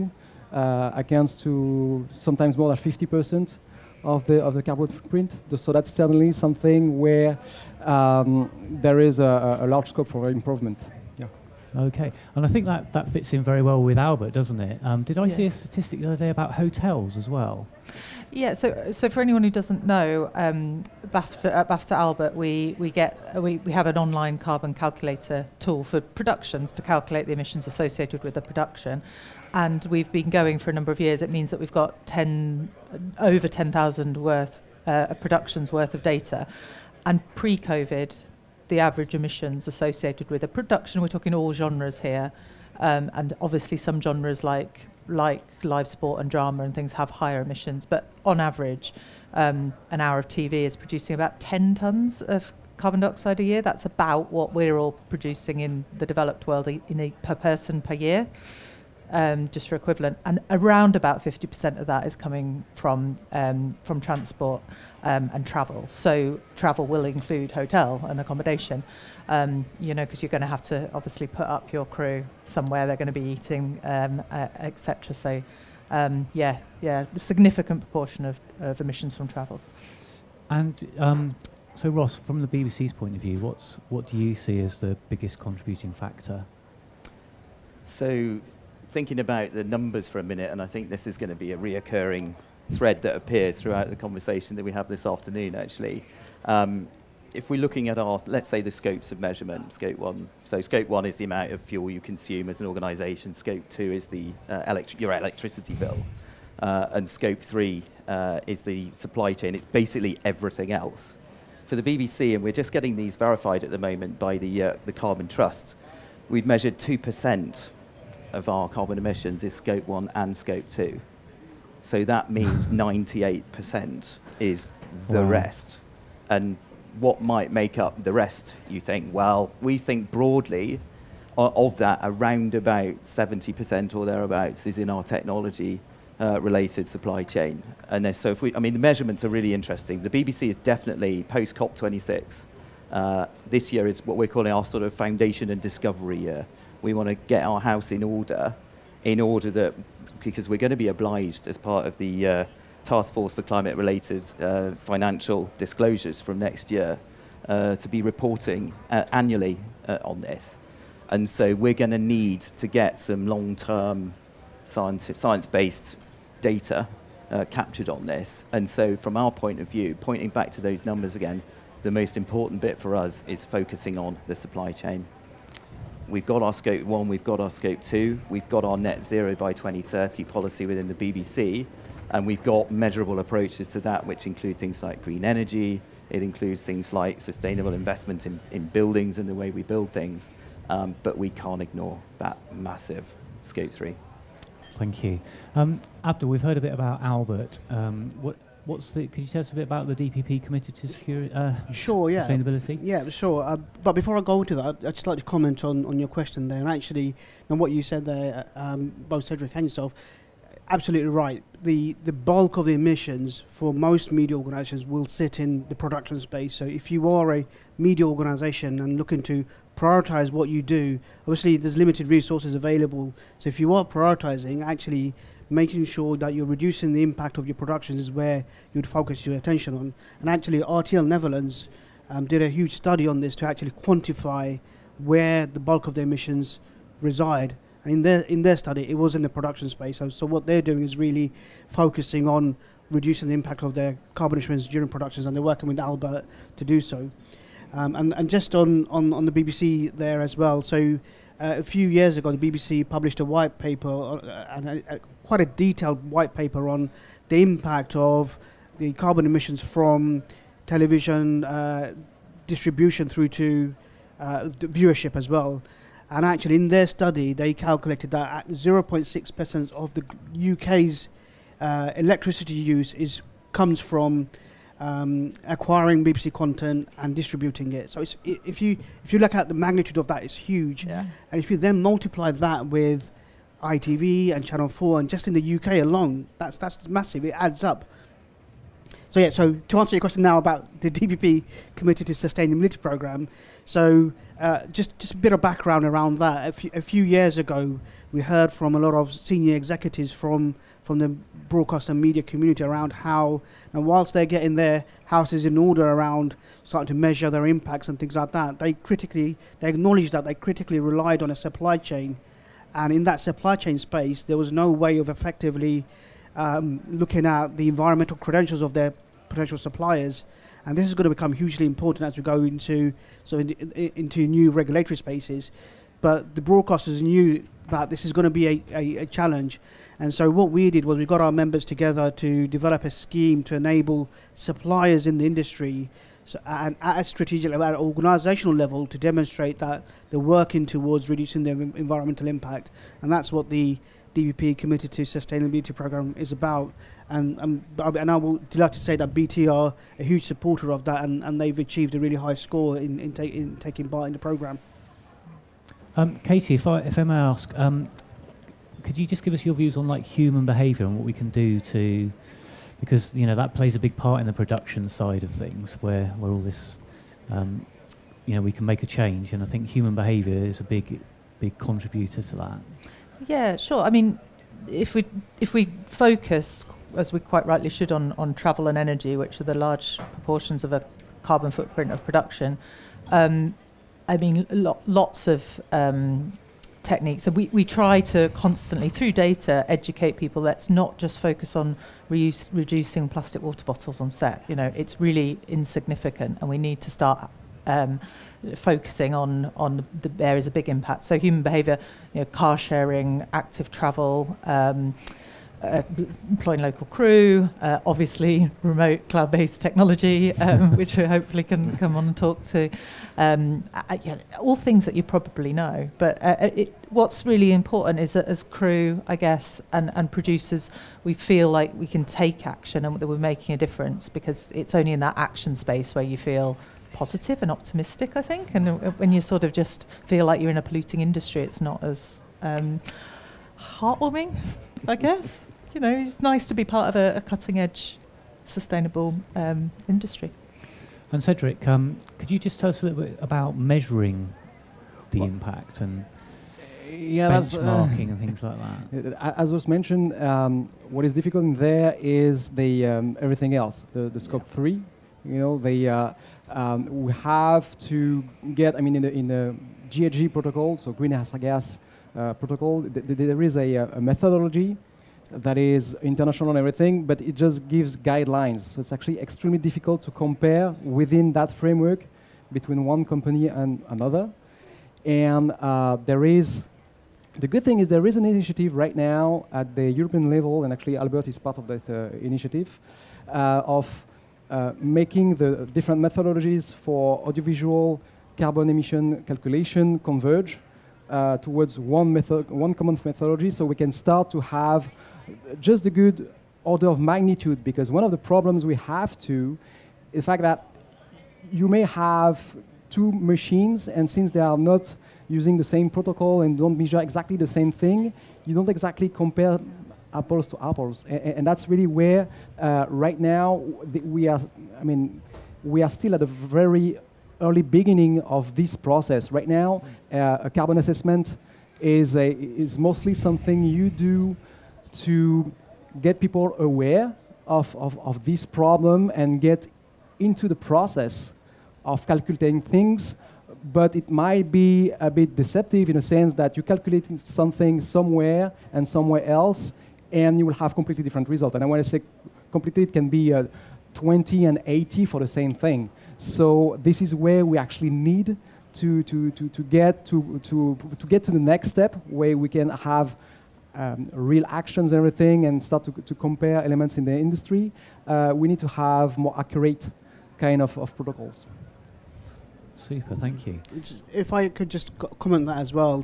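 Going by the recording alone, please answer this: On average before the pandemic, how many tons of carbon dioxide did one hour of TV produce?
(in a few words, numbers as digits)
10 tons.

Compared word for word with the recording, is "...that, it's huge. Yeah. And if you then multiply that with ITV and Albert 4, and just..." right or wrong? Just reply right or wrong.
wrong.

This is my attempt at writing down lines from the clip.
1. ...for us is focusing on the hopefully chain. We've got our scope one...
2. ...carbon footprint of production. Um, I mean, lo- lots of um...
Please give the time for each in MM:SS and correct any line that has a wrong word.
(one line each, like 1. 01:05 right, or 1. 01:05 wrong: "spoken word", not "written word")
1. 02:52 wrong: "supply", not "hopefully"
2. 06:21 right.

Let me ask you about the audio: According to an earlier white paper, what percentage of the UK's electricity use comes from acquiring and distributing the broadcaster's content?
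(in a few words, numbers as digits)
0.6%.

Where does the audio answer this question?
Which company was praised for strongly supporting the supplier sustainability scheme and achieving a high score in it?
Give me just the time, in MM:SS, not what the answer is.
05:49.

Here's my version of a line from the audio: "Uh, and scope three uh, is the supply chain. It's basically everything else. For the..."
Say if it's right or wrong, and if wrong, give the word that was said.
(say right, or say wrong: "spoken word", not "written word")
right.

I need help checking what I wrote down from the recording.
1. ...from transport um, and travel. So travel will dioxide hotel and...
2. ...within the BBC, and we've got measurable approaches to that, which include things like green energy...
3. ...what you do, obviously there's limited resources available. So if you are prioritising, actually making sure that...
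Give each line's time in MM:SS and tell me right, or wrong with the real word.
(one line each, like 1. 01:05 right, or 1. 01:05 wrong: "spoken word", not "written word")
1. 01:03 wrong: "include", not "dioxide"
2. 03:00 right
3. 03:40 right.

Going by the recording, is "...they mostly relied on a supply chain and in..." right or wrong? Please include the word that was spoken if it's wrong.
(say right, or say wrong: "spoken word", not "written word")
wrong: "critically", not "mostly".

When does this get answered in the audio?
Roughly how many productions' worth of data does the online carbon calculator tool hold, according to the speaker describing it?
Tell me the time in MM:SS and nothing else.
00:33.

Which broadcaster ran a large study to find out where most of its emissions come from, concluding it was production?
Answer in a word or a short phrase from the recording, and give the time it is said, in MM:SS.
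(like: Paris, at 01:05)
RTL Netherlands, at 03:50.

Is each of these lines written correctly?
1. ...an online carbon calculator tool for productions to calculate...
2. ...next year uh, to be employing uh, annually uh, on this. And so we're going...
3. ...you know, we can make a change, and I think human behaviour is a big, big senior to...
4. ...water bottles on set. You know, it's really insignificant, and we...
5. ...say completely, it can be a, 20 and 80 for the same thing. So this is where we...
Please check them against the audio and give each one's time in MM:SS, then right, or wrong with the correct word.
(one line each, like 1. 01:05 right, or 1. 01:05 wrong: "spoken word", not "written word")
1. 00:23 right
2. 02:36 wrong: "reporting", not "employing"
3. 06:08 wrong: "contributor", not "senior"
4. 06:33 right
5. 09:01 right.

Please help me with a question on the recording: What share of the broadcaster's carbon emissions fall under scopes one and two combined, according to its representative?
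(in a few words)
2%.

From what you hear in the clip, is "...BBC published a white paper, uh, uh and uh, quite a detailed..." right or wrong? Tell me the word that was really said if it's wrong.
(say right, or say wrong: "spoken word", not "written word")
right.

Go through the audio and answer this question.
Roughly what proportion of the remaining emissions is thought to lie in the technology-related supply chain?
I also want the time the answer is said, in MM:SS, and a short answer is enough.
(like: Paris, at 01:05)
70%, at 02:13.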